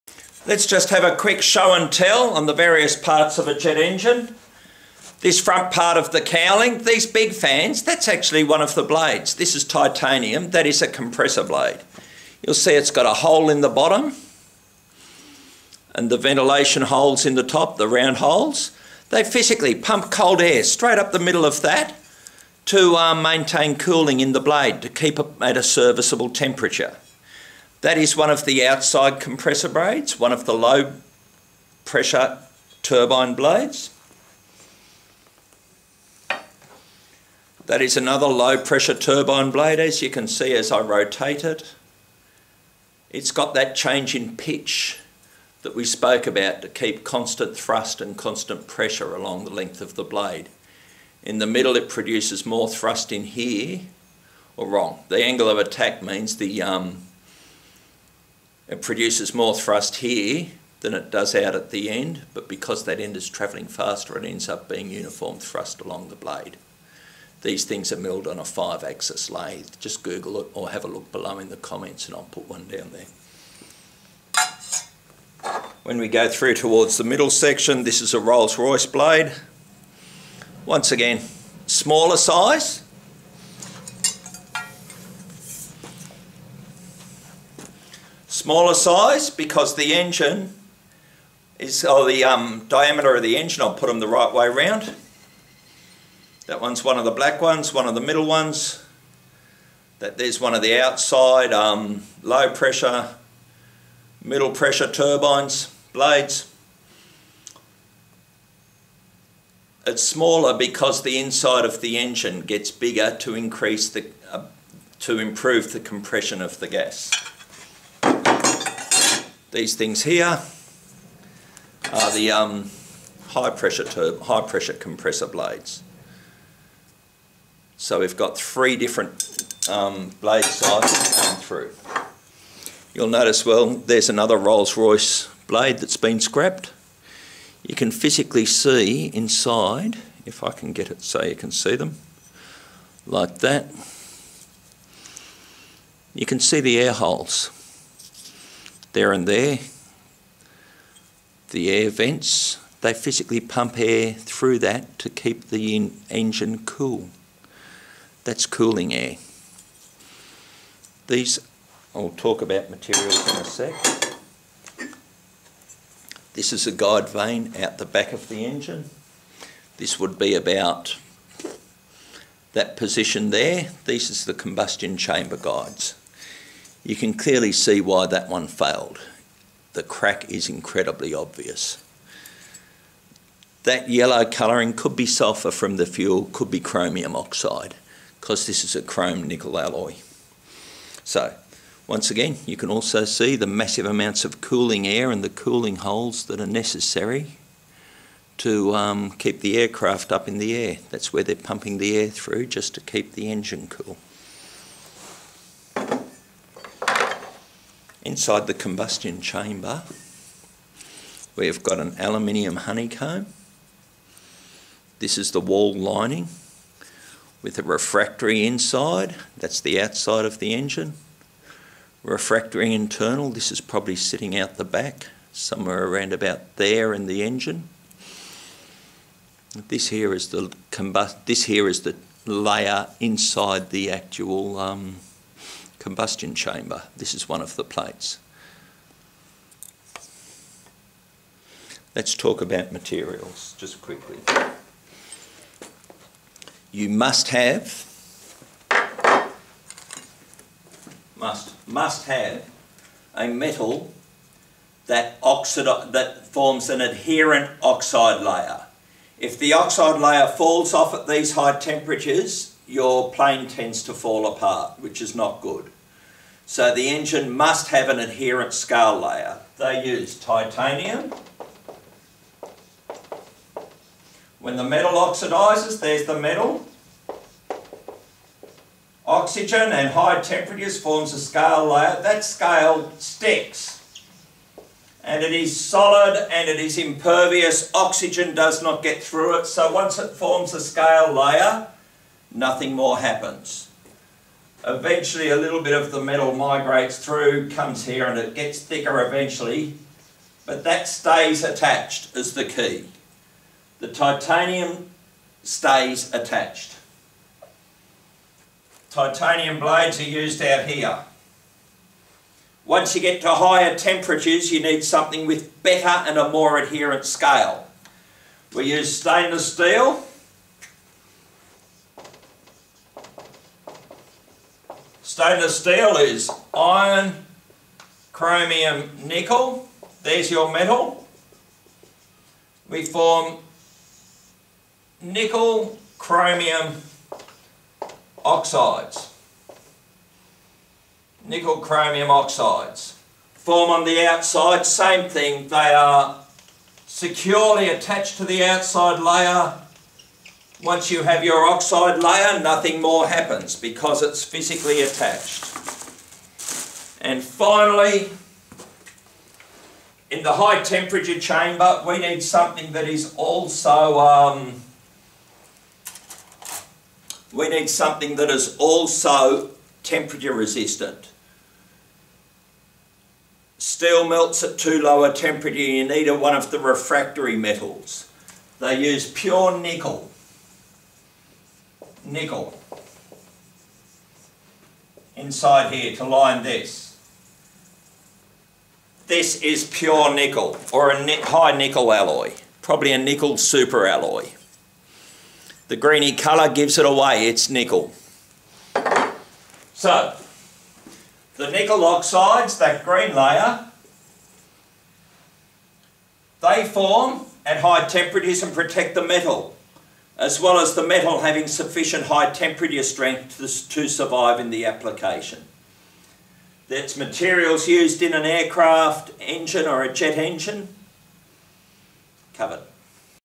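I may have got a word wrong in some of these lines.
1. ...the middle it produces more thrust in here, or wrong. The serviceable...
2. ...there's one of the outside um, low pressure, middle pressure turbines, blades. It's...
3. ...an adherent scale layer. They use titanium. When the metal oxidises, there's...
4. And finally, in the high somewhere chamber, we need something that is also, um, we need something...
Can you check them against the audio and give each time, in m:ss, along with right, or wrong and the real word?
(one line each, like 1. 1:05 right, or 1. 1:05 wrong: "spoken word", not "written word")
1. 0:51 wrong: "angle", not "serviceable"
2. 1:40 right
3. 4:27 right
4. 5:57 wrong: "temperature", not "somewhere".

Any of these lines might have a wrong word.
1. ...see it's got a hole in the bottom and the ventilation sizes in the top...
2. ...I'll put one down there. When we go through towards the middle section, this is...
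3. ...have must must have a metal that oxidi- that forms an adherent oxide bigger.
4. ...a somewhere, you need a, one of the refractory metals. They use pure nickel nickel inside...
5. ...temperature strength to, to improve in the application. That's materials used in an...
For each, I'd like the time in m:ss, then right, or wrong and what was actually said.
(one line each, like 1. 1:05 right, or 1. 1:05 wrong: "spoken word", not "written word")
1. 0:12 wrong: "holes", not "sizes"
2. 1:12 right
3. 4:07 wrong: "layer", not "bigger"
4. 6:15 wrong: "temperature", not "somewhere"
5. 6:52 wrong: "survive", not "improve".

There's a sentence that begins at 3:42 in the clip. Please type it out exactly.
Refractory internal, this is probably sitting out the back, somewhere around about there in the engine.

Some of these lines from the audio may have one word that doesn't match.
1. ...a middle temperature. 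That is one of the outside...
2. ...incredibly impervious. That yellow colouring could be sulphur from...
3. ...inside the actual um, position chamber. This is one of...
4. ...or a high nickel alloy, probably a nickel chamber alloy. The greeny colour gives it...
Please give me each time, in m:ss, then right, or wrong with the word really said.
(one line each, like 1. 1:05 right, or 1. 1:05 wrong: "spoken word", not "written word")
1. 0:25 wrong: "serviceable", not "middle"
2. 3:00 wrong: "obvious", not "impervious"
3. 3:52 wrong: "combustion", not "position"
4. 6:30 wrong: "super", not "chamber".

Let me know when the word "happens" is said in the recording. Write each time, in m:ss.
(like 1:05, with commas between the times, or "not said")
4:52, 5:53.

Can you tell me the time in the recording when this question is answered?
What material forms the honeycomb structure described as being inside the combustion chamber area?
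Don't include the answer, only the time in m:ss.
3:31.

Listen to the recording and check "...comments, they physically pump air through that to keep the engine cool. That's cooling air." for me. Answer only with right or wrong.
wrong.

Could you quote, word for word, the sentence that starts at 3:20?
That's where they're pumping the air through just to keep the engine cool.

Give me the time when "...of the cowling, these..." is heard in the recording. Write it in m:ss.
0:05.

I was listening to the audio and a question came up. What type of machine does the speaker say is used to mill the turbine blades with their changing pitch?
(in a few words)
five-axis lathe.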